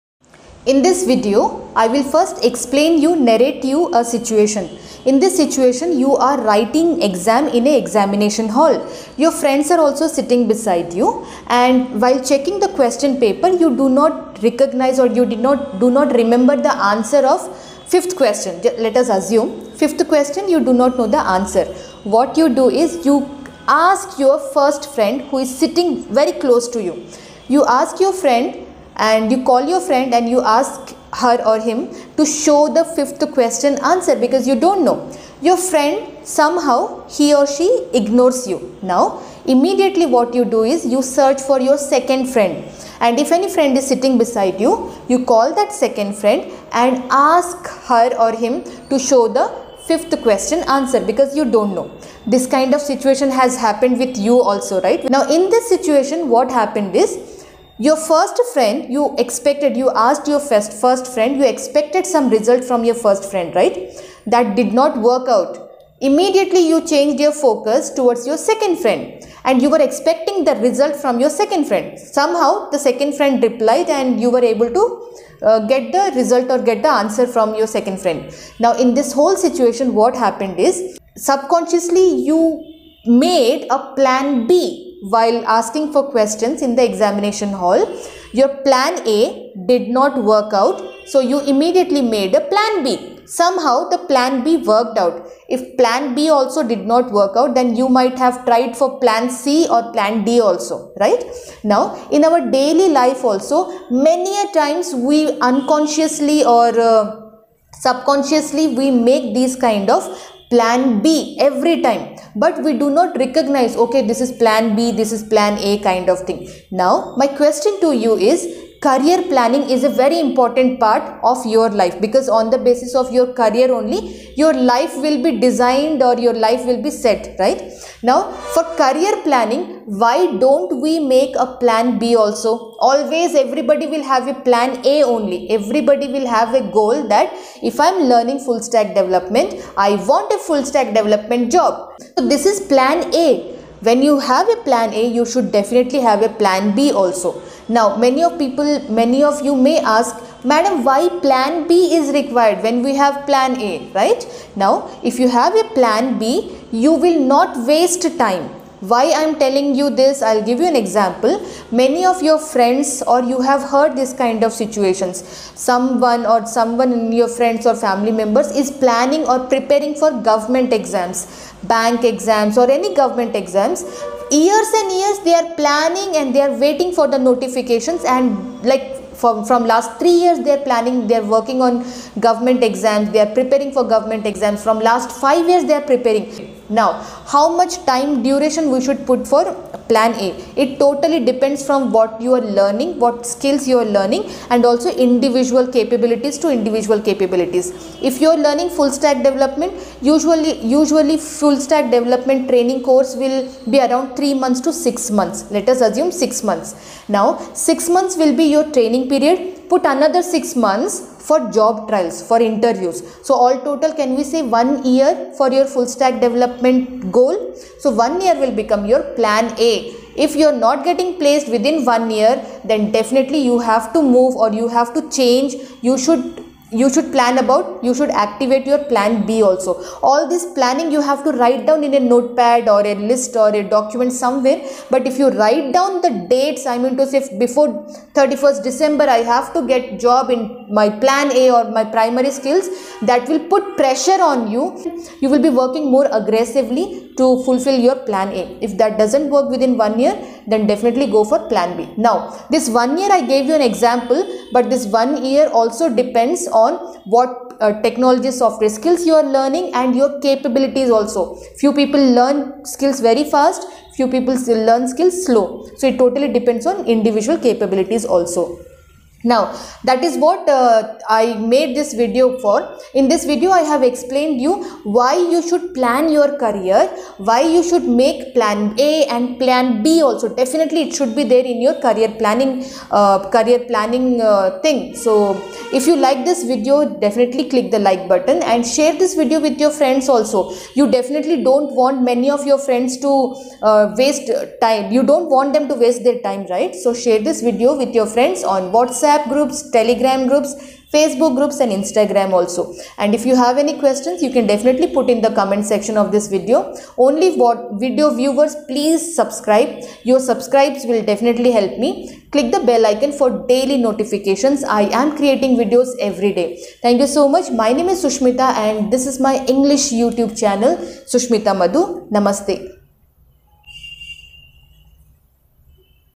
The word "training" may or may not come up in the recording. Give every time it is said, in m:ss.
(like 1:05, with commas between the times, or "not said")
3:22, 3:28.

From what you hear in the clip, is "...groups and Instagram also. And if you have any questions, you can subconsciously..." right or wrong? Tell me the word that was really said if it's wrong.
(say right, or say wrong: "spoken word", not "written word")
wrong: "definitely", not "subconsciously".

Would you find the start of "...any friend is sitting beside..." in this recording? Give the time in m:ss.
0:43.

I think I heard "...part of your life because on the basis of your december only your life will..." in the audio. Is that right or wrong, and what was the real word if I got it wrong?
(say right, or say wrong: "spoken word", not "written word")
wrong: "career", not "december".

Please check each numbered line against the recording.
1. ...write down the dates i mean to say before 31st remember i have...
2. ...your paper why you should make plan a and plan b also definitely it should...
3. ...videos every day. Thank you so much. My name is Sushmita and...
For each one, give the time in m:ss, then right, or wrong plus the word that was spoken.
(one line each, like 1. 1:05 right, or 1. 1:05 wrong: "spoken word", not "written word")
1. 3:55 wrong: "december", not "remember"
2. 4:36 wrong: "career", not "paper"
3. 5:15 right.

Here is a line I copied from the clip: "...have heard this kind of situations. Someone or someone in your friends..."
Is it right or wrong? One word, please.
right.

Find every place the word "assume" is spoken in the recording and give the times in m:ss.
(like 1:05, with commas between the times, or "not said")
0:19, 3:25.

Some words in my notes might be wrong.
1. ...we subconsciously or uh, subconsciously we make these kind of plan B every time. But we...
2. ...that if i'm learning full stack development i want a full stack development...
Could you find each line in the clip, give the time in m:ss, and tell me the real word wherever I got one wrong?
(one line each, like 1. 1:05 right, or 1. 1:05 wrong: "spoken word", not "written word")
1. 1:44 wrong: "unconsciously", not "subconsciously"
2. 2:17 right.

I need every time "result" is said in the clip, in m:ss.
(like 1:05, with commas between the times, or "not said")
1:02, 1:10, 1:16.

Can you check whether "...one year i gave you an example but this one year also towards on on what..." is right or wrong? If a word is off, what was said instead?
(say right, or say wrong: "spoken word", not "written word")
wrong: "depends", not "towards".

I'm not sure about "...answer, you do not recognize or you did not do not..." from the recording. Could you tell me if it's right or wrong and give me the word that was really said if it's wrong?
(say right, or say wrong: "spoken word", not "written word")
wrong: "paper", not "answer".